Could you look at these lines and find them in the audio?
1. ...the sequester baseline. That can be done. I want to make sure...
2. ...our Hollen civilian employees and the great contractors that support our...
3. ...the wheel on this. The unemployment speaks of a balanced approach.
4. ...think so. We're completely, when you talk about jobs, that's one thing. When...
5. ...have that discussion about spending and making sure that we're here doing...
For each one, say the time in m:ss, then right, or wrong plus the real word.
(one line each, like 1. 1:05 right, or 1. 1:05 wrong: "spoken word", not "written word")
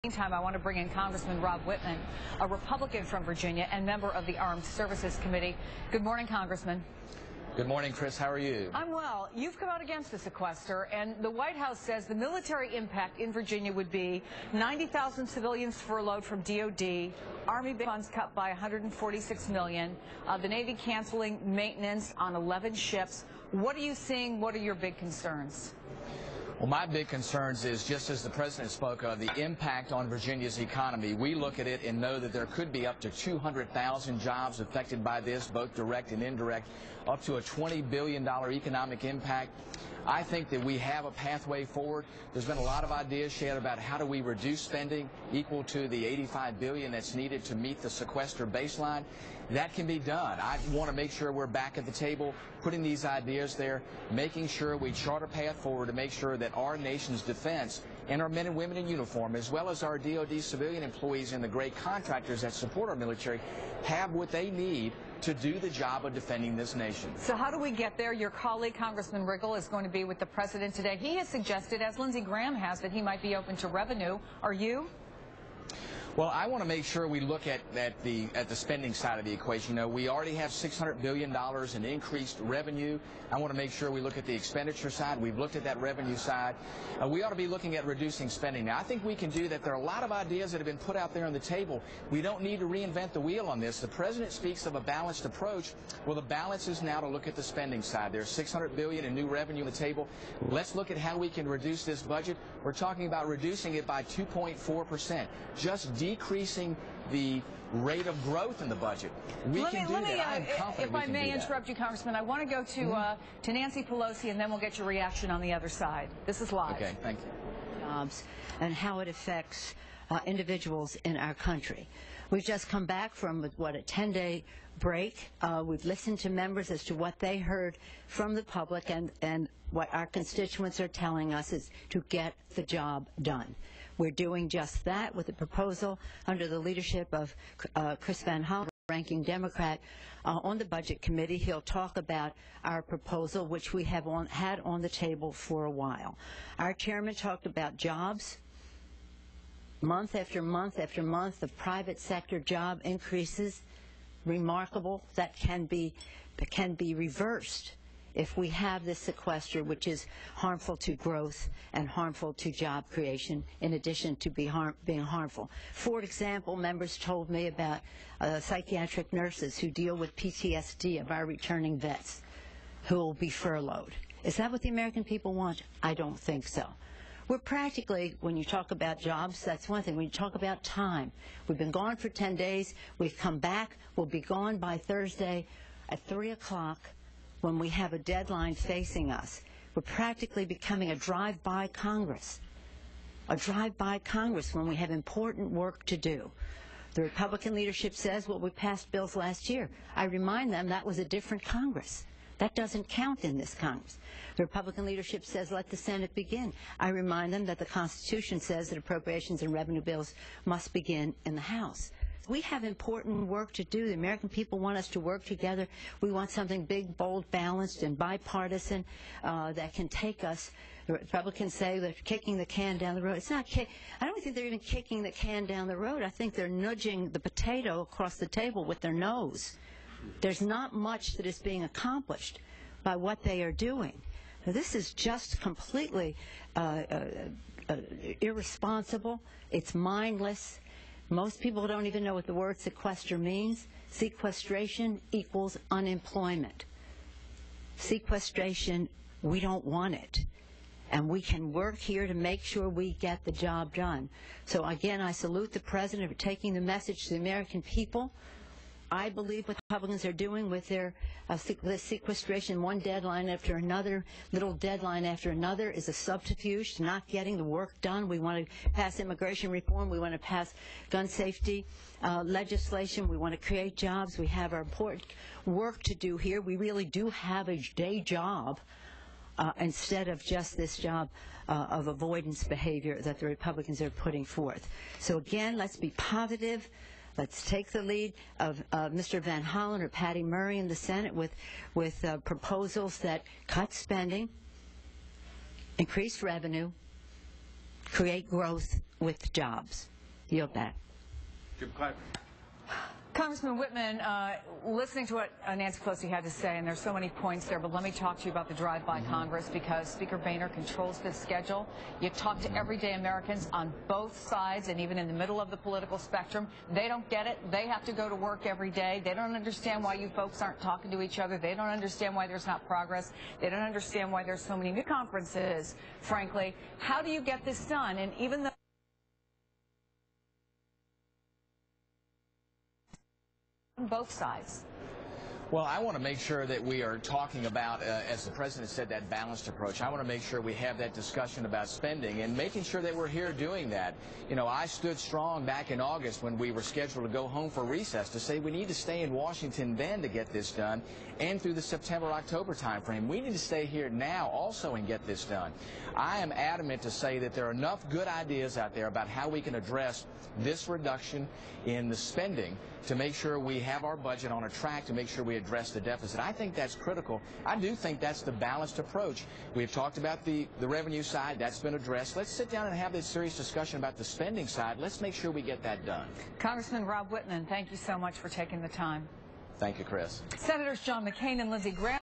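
1. 0:47 right
2. 0:59 wrong: "DOD", not "Hollen"
3. 1:33 wrong: "president", not "unemployment"
4. 2:56 wrong: "practically", not "completely"
5. 5:40 right.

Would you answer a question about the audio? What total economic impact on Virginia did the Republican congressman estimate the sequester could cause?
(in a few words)
$20 billion.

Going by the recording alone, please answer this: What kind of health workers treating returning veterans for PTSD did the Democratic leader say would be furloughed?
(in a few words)
psychiatric nurses.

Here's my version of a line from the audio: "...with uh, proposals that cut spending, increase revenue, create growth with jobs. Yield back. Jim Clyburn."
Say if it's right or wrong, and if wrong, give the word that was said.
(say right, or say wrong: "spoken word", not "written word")
right.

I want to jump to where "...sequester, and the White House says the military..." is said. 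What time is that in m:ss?
0:10.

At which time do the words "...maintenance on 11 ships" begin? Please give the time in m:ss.
0:21.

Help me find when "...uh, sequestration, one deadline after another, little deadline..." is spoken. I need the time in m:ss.
4:21.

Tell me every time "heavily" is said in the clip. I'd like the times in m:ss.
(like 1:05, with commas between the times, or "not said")
not said.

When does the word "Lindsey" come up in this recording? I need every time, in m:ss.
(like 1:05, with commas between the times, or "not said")
1:11, 6:21.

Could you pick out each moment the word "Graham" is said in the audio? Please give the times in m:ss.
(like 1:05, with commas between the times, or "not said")
1:12, 6:21.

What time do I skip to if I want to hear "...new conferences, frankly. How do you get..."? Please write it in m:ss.
5:24.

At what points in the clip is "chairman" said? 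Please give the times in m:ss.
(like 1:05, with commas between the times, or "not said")
2:26.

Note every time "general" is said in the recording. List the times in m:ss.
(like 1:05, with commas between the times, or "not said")
not said.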